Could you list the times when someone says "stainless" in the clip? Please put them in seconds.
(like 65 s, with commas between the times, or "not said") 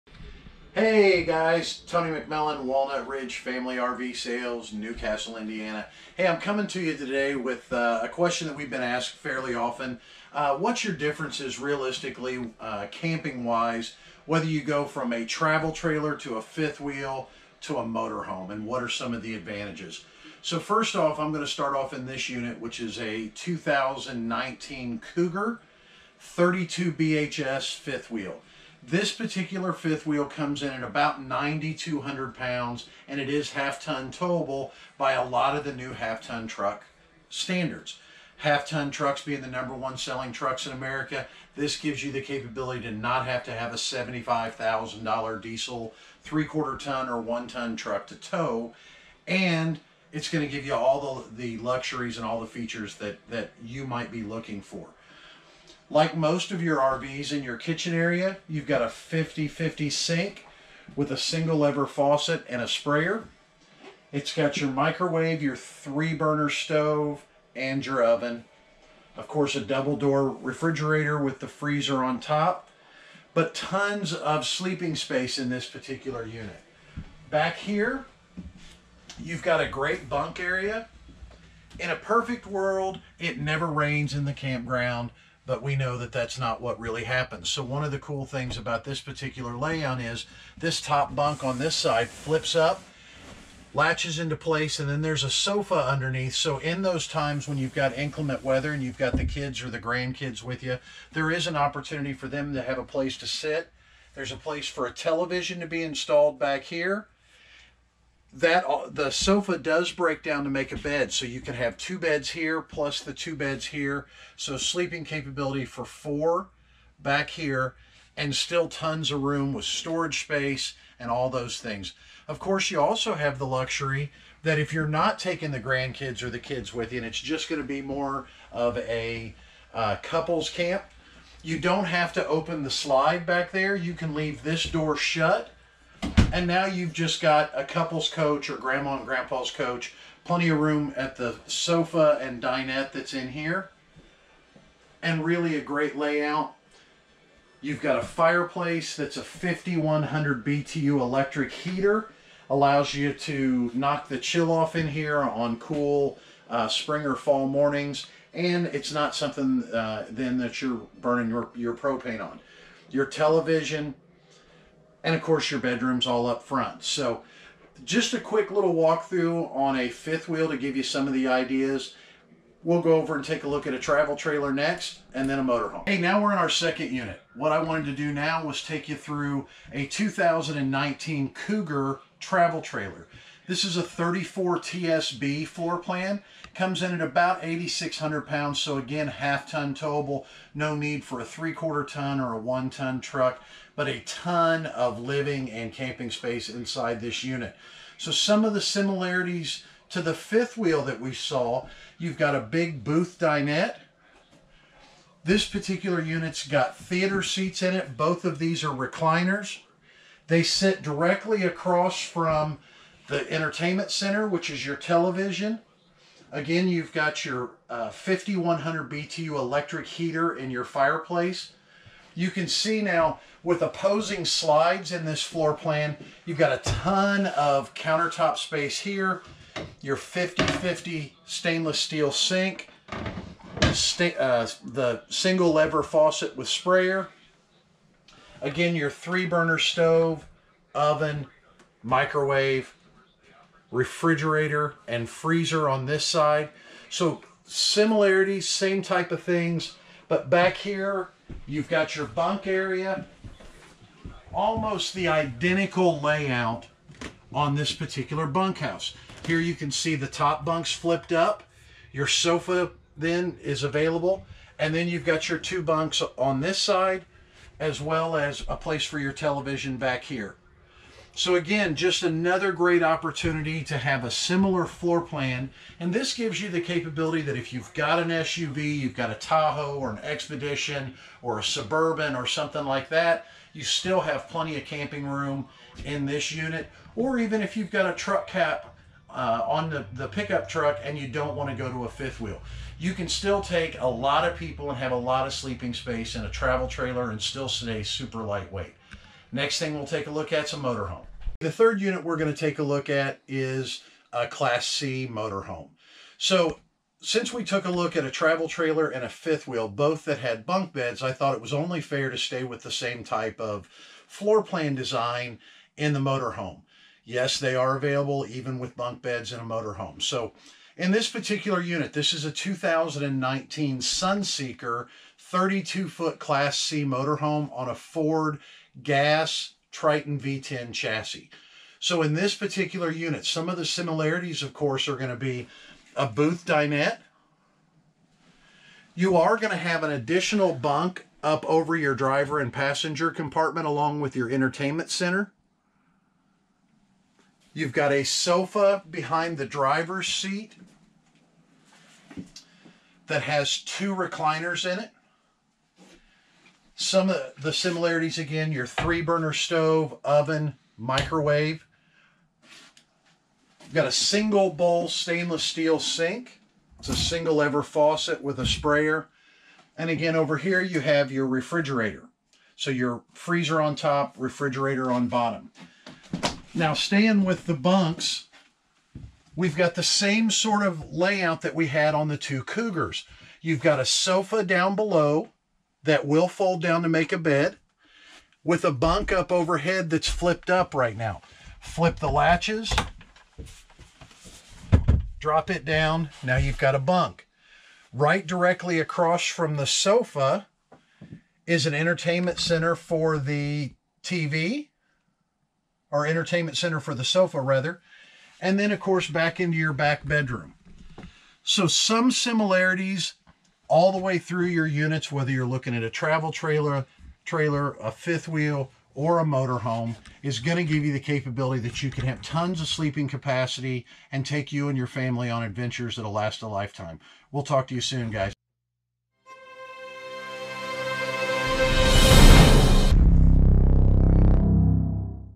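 231 s, 364 s.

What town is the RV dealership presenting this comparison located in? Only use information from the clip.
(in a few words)
Newcastle, Indiana.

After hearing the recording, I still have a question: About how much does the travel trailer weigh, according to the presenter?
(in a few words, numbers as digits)
8,600 pounds.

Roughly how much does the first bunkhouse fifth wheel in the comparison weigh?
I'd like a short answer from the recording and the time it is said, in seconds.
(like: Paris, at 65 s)
9,200 pounds, at 31 s.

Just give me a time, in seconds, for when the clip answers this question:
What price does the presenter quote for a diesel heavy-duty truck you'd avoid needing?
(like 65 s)
43 s.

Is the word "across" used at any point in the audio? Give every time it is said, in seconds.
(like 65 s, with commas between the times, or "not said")
211 s, 398 s.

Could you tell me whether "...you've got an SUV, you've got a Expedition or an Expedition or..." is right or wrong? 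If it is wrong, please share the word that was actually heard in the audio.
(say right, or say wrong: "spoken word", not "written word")
wrong: "Tahoe", not "Expedition".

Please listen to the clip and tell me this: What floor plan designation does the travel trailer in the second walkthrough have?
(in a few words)
34 TSB.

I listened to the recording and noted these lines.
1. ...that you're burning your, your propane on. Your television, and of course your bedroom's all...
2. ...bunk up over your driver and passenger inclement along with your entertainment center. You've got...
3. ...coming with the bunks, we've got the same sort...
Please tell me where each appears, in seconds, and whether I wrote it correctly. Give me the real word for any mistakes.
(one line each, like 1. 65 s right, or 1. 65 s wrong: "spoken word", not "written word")
1. 160 s right
2. 340 s wrong: "compartment", not "inclement"
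3. 376 s wrong: "staying", not "coming".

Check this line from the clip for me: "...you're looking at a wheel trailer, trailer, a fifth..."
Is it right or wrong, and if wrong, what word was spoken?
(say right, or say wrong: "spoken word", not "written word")
wrong: "travel", not "wheel".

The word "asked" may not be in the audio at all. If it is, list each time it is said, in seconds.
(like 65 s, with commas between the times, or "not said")
8 s.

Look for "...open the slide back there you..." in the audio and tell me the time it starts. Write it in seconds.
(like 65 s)
132 s.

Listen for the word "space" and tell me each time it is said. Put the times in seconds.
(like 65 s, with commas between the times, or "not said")
74 s, 120 s, 196 s, 228 s, 295 s.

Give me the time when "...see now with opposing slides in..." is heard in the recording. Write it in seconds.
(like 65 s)
222 s.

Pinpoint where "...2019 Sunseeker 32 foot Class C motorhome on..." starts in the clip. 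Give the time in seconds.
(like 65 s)
322 s.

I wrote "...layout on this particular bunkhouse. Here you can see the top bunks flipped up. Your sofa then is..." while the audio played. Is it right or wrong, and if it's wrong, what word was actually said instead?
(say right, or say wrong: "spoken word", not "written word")
right.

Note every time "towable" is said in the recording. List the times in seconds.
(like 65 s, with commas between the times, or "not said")
34 s, 189 s.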